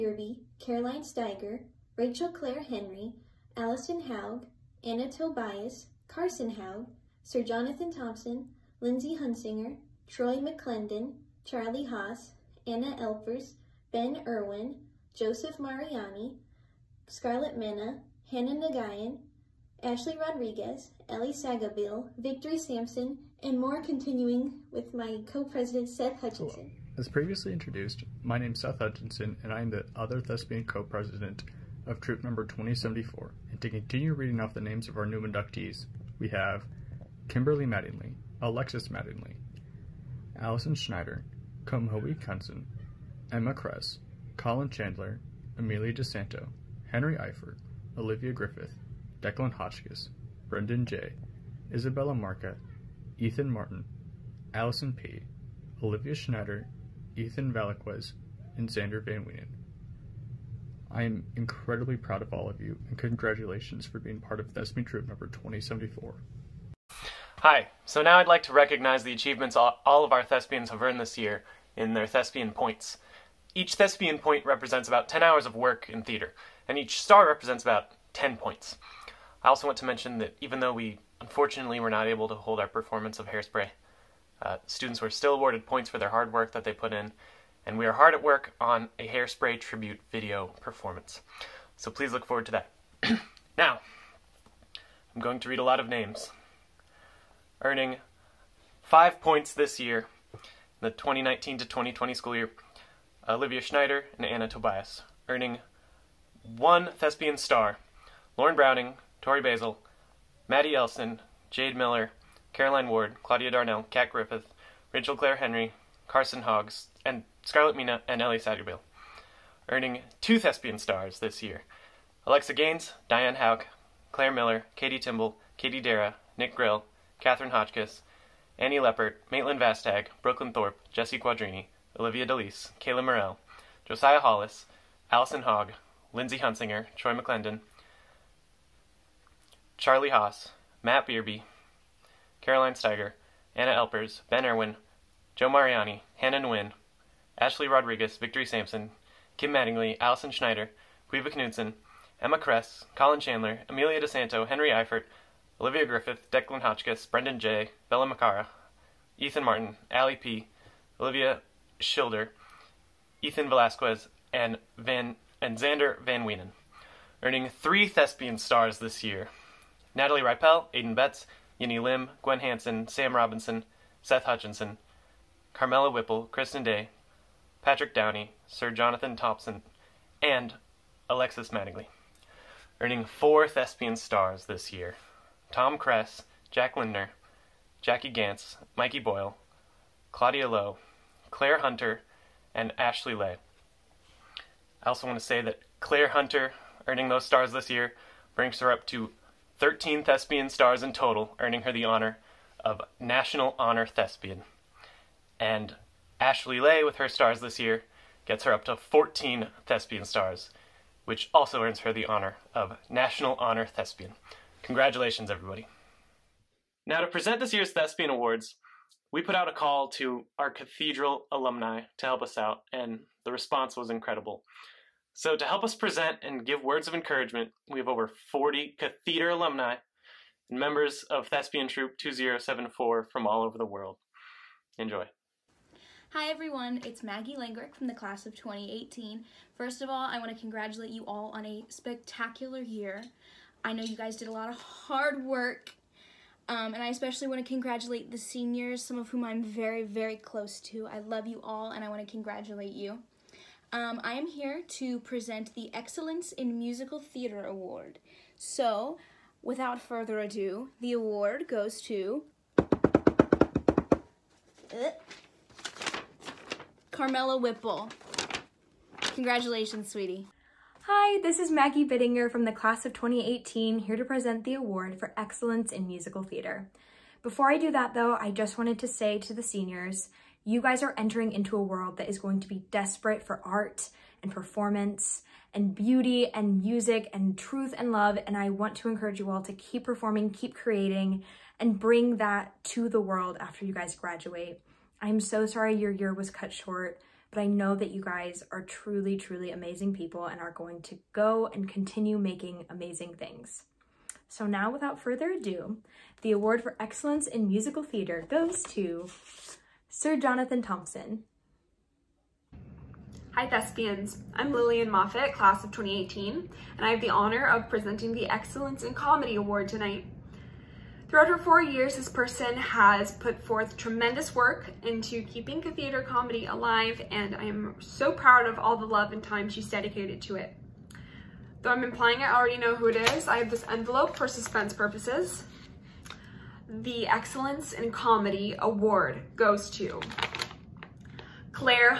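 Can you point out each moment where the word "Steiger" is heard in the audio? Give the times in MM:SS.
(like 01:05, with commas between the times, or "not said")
00:01, 02:22.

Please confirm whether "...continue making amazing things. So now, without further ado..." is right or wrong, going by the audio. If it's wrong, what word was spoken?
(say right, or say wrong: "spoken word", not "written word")
right.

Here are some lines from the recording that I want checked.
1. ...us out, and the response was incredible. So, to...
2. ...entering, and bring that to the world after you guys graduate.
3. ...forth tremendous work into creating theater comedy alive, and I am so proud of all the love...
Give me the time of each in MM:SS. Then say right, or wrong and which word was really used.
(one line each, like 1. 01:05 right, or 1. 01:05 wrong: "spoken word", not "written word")
1. 03:42 right
2. 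04:50 wrong: "creating", not "entering"
3. 05:23 wrong: "keeping", not "creating".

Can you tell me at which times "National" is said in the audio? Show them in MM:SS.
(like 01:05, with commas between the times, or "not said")
03:22, 03:32.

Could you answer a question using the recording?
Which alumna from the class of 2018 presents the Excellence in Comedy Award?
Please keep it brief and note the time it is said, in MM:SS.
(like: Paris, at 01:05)
Lillian Moffat, at 05:14.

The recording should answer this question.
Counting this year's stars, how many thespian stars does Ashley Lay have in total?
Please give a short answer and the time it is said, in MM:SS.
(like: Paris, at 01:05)
14, at 03:28.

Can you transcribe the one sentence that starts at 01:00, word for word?
I am incredibly proud of all of you, and congratulations for being part of Thespian Troop number 2074.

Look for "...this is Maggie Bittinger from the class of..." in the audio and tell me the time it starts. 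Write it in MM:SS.
04:31.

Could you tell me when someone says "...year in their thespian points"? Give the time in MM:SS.
01:11.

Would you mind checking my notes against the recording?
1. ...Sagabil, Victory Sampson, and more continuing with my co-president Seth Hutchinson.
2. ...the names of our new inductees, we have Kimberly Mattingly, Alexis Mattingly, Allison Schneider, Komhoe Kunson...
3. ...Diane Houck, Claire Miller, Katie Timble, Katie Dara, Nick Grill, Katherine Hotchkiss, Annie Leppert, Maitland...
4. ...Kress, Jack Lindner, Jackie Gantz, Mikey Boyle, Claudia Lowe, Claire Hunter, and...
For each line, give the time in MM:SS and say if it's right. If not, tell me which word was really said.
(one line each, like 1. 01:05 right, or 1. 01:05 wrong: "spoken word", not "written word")
1. 00:21 right
2. 00:34 right
3. 02:03 right
4. 03:05 right.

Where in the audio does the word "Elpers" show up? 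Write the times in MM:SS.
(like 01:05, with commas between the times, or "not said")
00:13, 02:23.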